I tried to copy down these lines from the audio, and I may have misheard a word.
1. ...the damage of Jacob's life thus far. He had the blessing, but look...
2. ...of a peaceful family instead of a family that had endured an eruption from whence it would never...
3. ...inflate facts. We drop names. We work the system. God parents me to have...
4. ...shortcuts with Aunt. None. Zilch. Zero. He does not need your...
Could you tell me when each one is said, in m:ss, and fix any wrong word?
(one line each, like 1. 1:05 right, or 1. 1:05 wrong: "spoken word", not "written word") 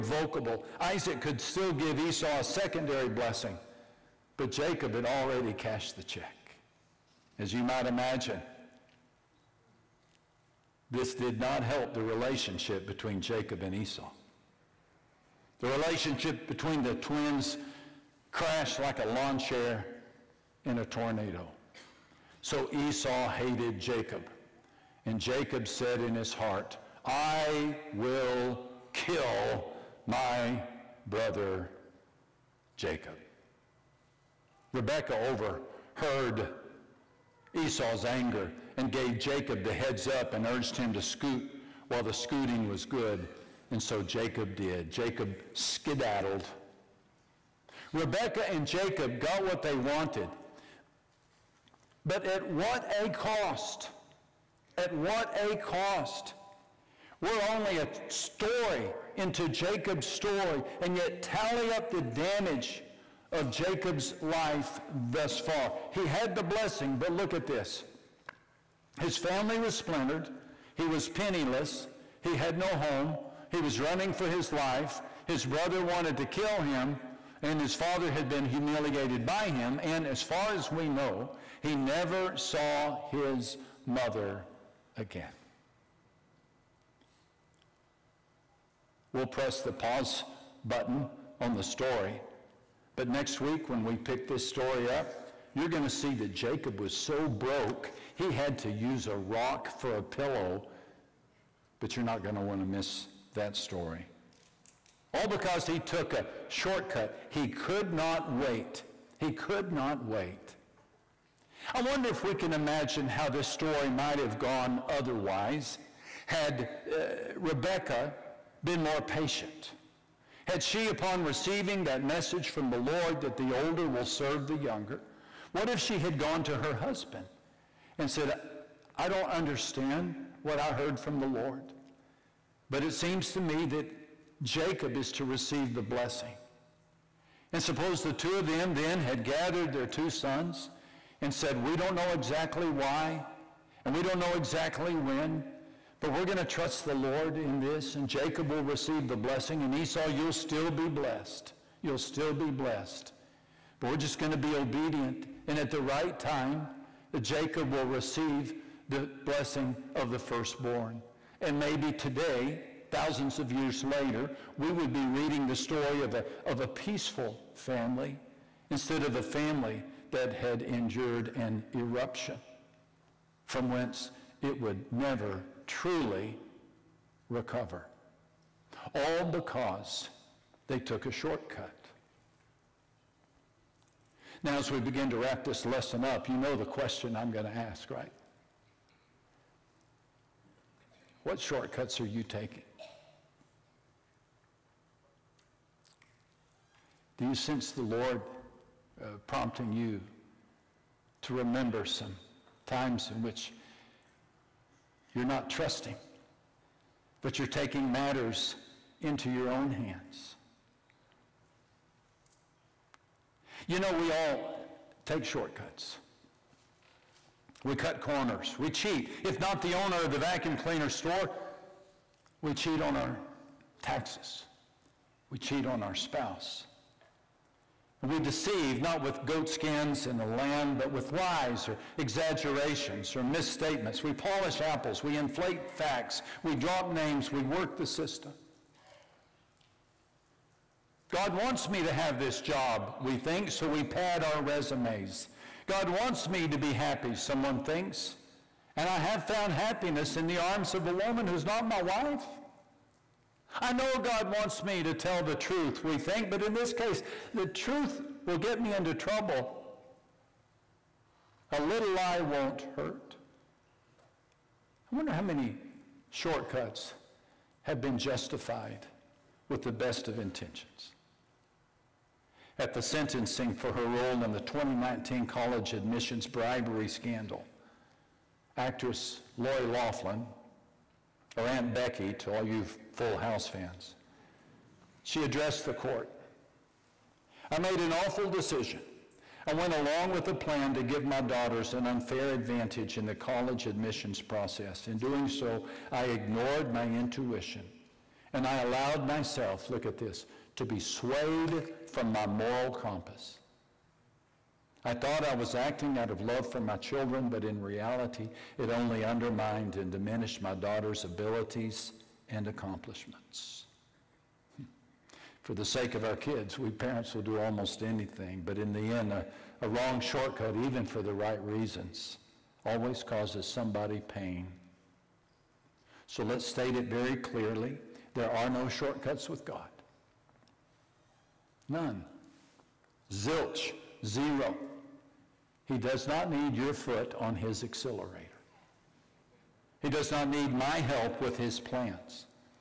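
1. 1:01 right
2. 2:46 right
3. 3:55 wrong: "wants", not "parents"
4. 5:28 wrong: "God", not "Aunt".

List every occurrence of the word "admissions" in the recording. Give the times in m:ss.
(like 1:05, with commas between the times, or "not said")
4:35, 4:53.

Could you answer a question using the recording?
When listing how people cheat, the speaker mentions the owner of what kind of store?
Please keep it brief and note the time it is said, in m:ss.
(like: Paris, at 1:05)
Vacuum cleaner store, at 3:40.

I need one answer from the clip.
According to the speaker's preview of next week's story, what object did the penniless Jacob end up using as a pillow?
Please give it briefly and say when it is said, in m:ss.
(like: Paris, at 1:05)
A rock, at 1:39.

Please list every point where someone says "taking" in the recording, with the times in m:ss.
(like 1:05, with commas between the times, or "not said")
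3:12, 3:27.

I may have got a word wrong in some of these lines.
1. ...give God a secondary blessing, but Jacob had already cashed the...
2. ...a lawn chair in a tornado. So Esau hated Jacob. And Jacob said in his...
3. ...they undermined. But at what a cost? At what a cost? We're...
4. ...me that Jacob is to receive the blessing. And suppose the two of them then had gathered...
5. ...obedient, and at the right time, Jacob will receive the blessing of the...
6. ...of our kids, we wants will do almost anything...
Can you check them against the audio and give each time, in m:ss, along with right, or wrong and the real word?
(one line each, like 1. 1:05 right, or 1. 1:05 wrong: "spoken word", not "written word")
1. 0:01 wrong: "Esau", not "God"
2. 0:18 right
3. 0:49 wrong: "wanted", not "undermined"
4. 2:13 right
5. 2:34 right
6. 5:15 wrong: "parents", not "wants".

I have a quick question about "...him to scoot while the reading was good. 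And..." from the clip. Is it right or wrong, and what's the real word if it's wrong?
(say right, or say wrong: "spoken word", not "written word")
wrong: "scooting", not "reading".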